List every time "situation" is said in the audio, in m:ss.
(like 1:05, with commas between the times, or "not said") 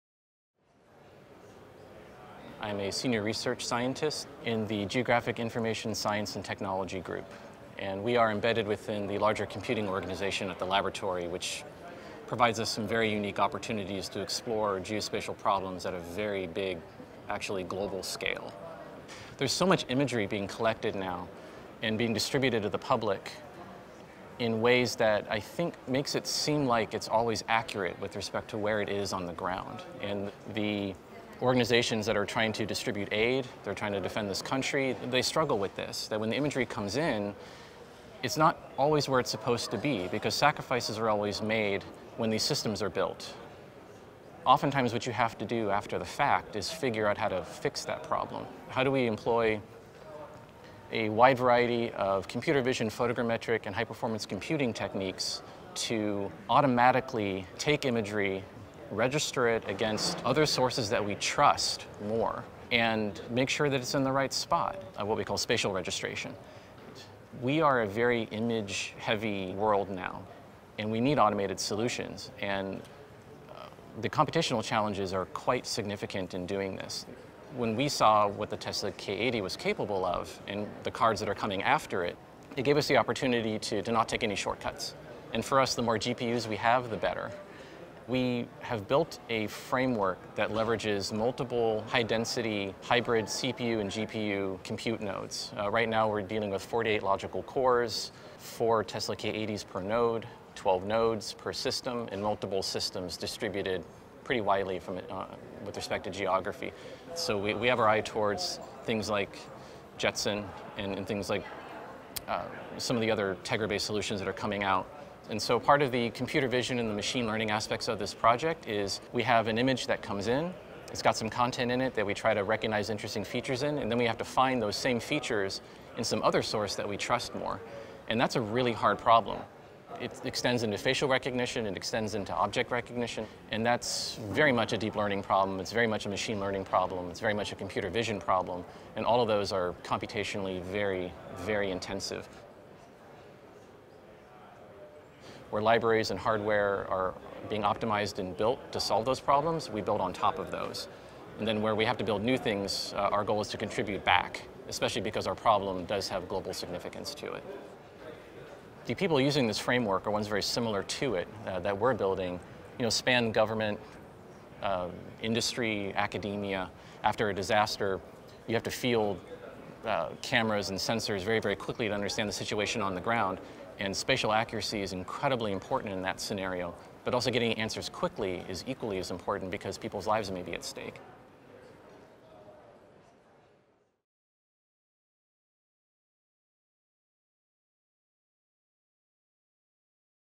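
2:52.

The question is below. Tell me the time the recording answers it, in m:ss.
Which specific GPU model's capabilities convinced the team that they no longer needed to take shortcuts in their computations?
1:18.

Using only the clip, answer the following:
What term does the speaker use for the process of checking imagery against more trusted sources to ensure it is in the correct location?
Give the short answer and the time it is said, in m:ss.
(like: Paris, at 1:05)
spatial registration, at 1:05.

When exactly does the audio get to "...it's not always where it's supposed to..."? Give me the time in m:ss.
0:38.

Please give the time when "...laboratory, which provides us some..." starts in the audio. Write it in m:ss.
0:10.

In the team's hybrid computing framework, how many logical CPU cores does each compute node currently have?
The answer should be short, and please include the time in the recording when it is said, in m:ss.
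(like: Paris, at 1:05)
48, at 1:36.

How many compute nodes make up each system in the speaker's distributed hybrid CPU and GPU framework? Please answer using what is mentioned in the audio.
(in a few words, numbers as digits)
12.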